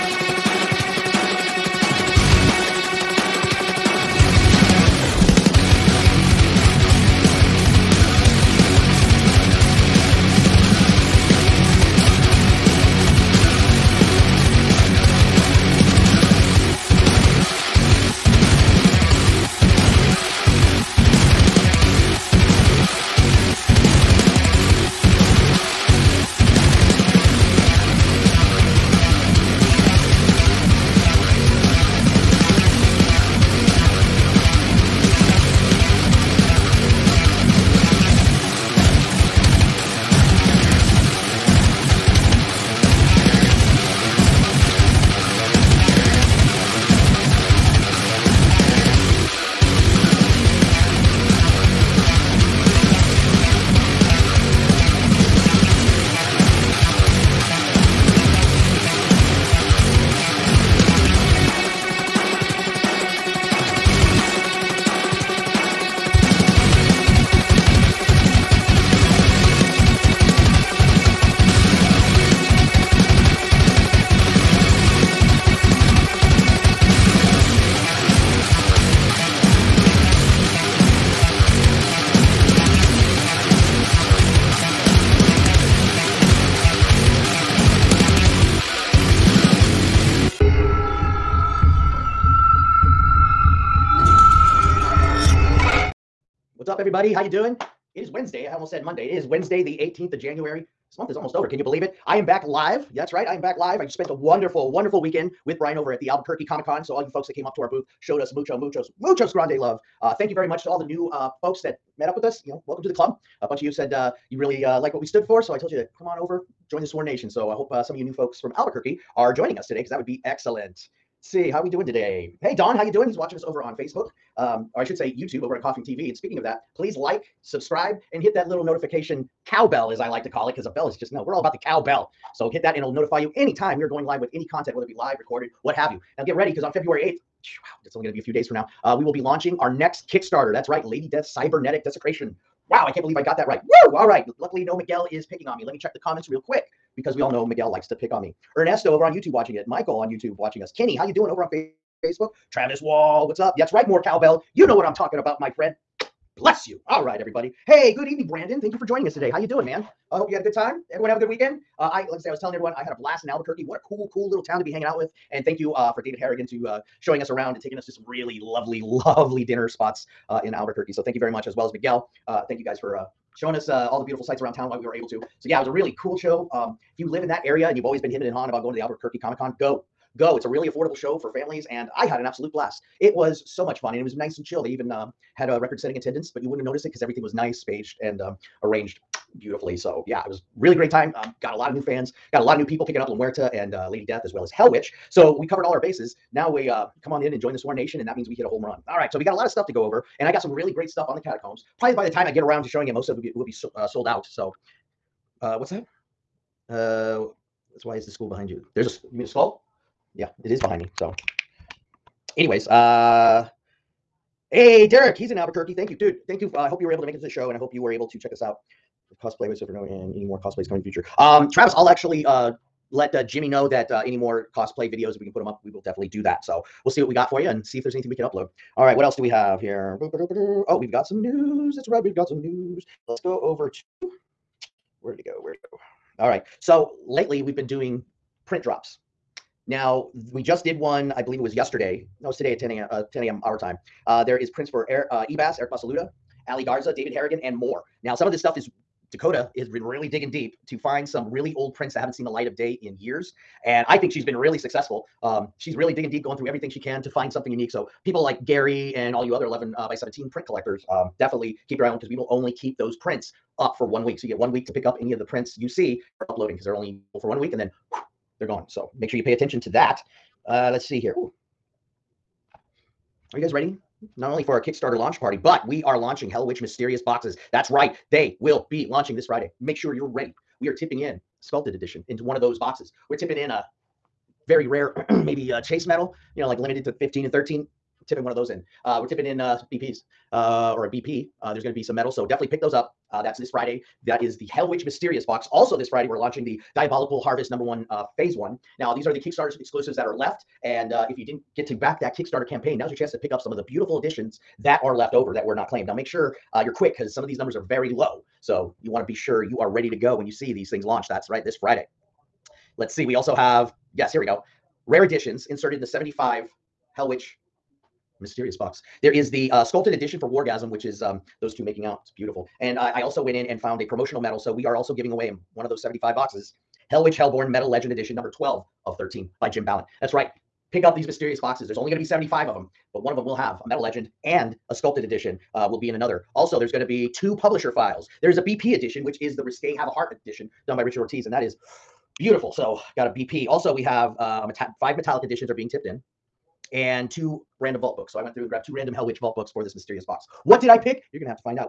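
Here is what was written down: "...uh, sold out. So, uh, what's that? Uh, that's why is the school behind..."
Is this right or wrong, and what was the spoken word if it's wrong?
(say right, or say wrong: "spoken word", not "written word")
right.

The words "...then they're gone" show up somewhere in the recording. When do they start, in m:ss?
4:27.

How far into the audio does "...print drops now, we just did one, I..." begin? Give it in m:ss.
3:58.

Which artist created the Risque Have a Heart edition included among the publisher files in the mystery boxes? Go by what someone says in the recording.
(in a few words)
Richard Ortiz.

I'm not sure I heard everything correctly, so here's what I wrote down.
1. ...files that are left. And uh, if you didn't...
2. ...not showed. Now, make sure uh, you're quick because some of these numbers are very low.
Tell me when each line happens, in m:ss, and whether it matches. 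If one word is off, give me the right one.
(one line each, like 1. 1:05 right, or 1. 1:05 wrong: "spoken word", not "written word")
1. 4:59 wrong: "exclusives", not "files"
2. 5:05 wrong: "claimed", not "showed".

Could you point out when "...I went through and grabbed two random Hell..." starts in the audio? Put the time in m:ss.
5:48.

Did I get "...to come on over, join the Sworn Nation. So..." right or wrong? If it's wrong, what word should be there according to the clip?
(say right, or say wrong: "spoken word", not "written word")
right.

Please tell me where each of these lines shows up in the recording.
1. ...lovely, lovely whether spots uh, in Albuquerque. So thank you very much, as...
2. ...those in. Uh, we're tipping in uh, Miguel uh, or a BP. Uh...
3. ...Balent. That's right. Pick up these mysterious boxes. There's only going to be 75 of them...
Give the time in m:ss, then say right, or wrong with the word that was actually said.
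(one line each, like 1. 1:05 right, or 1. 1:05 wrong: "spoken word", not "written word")
1. 2:48 wrong: "dinner", not "whether"
2. 4:48 wrong: "BPs", not "Miguel"
3. 5:29 right.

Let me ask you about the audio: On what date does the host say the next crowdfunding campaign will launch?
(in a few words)
February 8th.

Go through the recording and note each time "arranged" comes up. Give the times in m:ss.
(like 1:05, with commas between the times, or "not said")
3:08.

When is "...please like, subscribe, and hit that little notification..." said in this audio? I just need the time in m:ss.
2:06.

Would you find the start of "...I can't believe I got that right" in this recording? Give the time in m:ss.
2:22.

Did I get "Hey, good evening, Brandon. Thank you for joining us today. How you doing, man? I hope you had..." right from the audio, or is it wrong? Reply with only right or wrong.
right.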